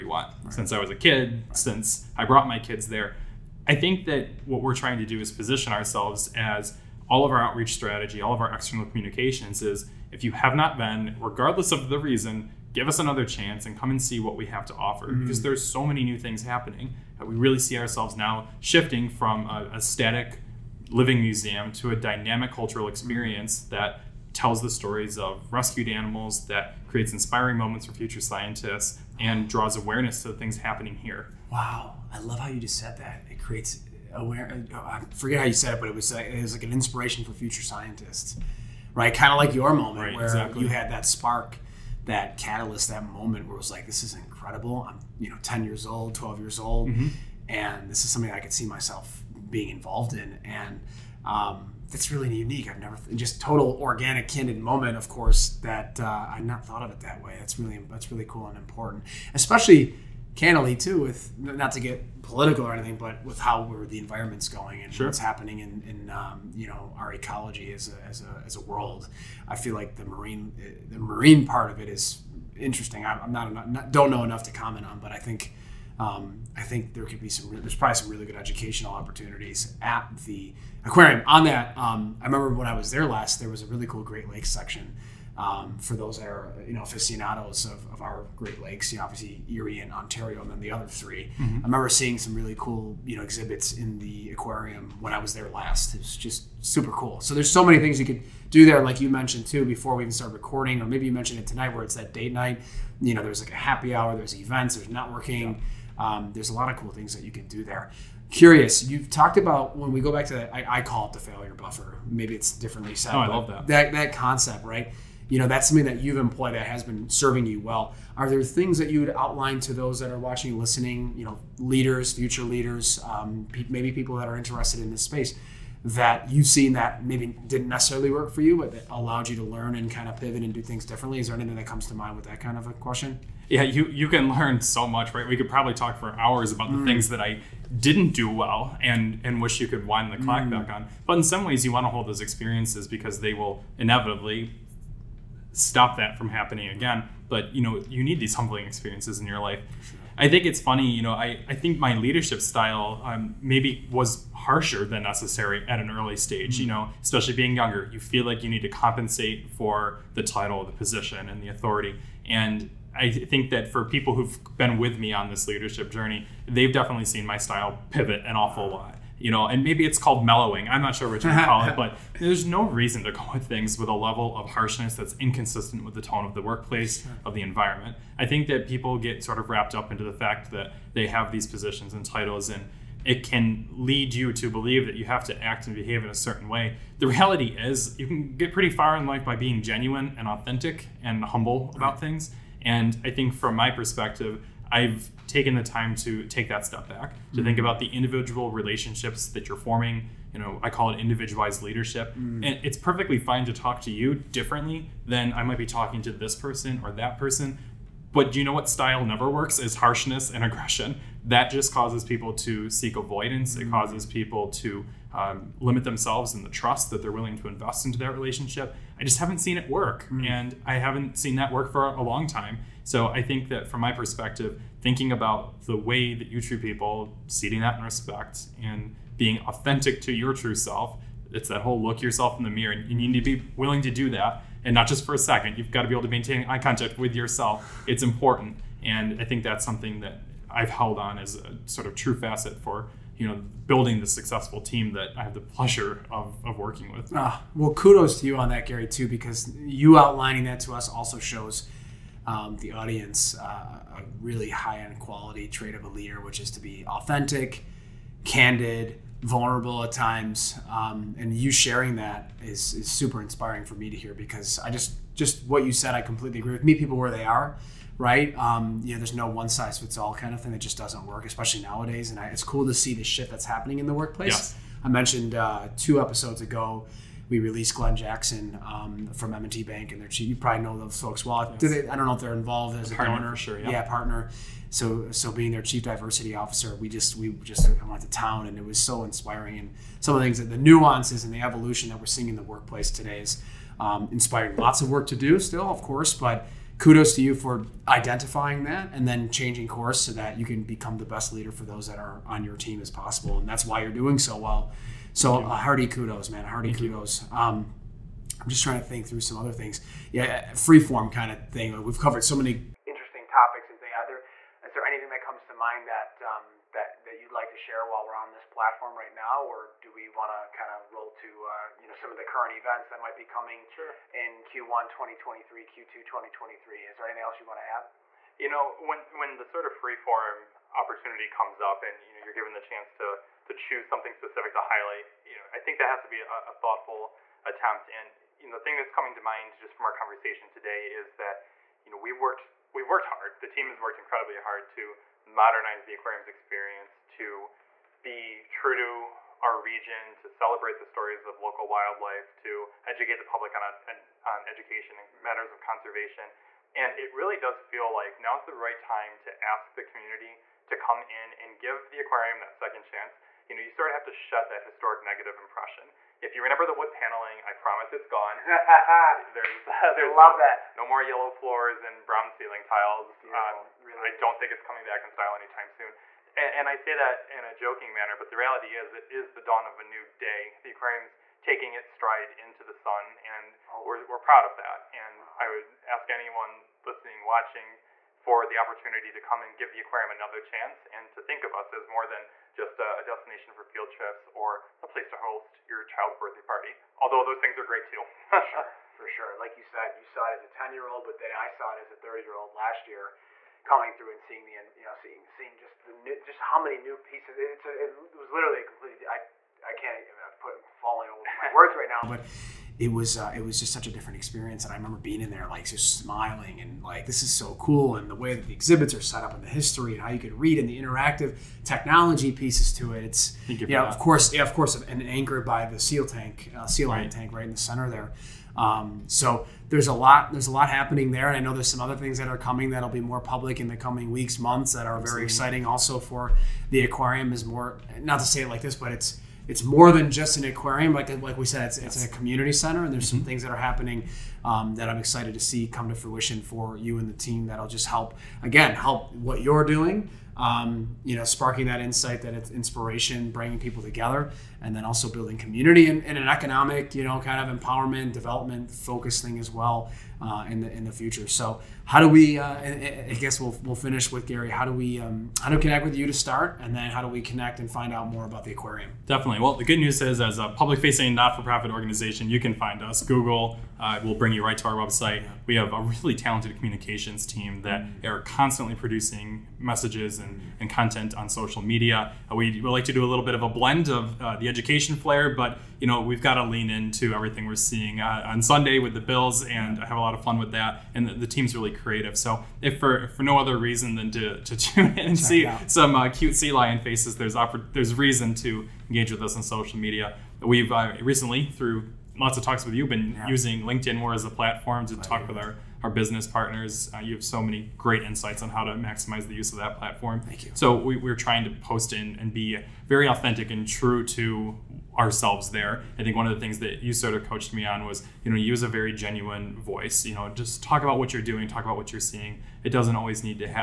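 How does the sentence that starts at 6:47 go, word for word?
It's a, it was literally a completely.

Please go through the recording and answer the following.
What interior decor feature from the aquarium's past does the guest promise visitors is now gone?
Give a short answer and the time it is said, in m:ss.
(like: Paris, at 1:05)
wood paneling, at 6:06.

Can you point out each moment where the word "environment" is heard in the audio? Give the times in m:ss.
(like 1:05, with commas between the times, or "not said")
1:03, 2:57.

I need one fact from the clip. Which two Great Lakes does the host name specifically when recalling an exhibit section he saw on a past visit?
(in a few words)
Erie and Ontario.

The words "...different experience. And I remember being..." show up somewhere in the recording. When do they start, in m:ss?
6:53.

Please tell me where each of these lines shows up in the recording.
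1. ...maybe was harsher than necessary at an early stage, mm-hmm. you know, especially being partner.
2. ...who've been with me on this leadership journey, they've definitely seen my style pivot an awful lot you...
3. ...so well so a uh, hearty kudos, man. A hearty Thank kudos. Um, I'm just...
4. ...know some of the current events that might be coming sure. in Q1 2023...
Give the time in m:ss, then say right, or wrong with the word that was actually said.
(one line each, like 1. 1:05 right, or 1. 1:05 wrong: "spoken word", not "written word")
1. 2:33 wrong: "younger", not "partner"
2. 2:44 right
3. 5:04 right
4. 5:21 right.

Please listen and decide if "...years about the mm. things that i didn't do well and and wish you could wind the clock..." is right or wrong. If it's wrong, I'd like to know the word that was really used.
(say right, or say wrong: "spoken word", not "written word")
wrong: "hours", not "years".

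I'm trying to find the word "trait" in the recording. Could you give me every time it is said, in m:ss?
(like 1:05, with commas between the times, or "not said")
4:15.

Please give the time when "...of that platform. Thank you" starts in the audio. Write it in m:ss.
8:29.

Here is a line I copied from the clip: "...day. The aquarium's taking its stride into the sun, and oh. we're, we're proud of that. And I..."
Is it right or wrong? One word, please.
right.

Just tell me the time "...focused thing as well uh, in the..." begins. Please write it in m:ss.
7:38.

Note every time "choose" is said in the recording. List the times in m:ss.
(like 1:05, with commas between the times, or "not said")
5:33.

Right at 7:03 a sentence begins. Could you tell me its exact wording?
It's you know, of course, yeah, of course, and anchored by the seal tank, uh, seal right.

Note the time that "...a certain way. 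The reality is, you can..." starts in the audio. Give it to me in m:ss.
3:06.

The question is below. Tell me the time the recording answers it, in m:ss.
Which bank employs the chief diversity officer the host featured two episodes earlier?
4:39.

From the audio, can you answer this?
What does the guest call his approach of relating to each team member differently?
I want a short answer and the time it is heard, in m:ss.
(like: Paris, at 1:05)
individualized leadership, at 3:20.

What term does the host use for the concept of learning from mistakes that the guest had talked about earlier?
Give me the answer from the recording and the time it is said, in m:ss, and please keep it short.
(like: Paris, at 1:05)
failure buffer, at 1:51.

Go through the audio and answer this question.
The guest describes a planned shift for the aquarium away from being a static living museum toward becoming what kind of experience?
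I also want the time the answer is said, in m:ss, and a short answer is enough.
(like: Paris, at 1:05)
dynamic cultural experience, at 0:21.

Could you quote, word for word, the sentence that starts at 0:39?
Kind of like your moment right, where exactly.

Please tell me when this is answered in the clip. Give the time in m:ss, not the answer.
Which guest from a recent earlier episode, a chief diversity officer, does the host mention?
4:37.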